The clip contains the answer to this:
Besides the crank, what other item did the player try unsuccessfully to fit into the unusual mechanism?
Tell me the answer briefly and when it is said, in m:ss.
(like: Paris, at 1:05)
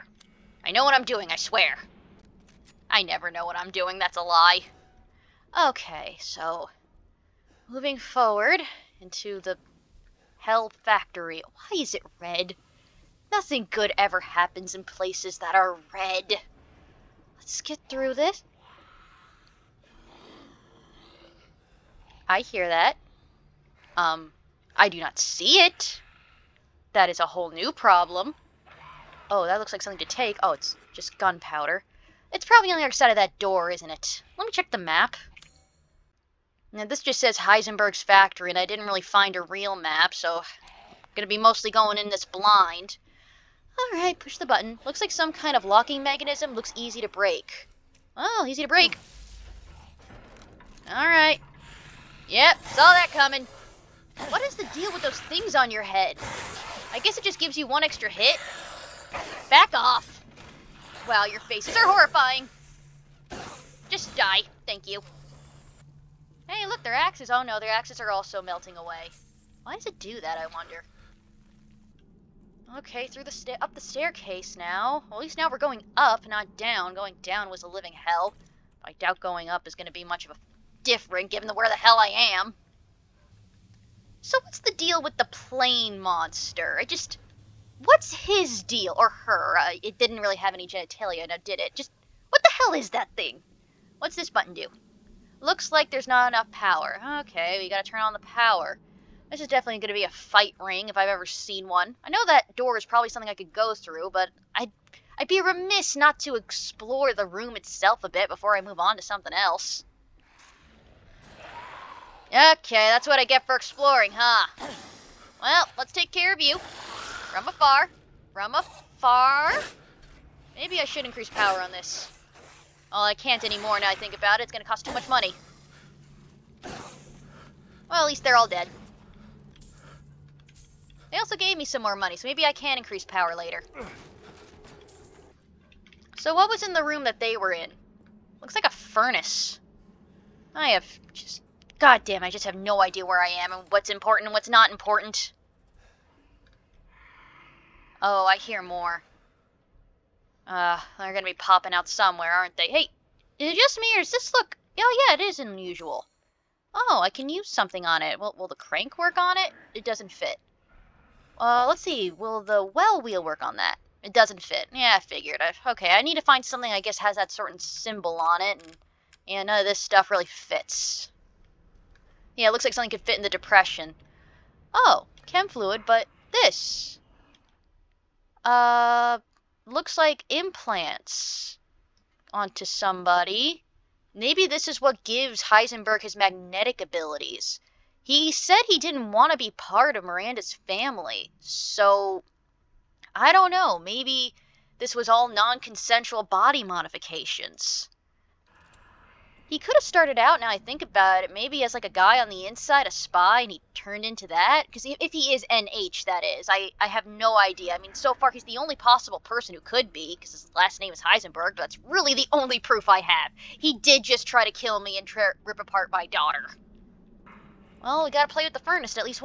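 Well wheel, at 2:42.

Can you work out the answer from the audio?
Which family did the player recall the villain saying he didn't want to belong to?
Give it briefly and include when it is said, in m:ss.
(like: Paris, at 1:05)
Miranda's, at 3:10.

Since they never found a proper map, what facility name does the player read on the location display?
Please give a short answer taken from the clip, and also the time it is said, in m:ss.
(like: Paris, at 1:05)
Heisenberg's Factory, at 0:37.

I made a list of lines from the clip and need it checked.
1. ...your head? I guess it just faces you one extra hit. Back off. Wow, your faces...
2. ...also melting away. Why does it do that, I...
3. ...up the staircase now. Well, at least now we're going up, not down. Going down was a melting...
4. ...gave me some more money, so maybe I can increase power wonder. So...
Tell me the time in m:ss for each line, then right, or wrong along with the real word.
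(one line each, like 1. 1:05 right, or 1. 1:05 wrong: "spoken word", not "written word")
1. 0:55 wrong: "gives", not "faces"
2. 1:08 right
3. 1:13 wrong: "living", not "melting"
4. 2:11 wrong: "later", not "wonder".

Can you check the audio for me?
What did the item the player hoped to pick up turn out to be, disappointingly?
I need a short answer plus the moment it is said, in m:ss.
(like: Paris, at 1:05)
Gunpowder, at 0:31.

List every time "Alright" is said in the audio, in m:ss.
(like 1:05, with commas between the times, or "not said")
0:43, 0:50.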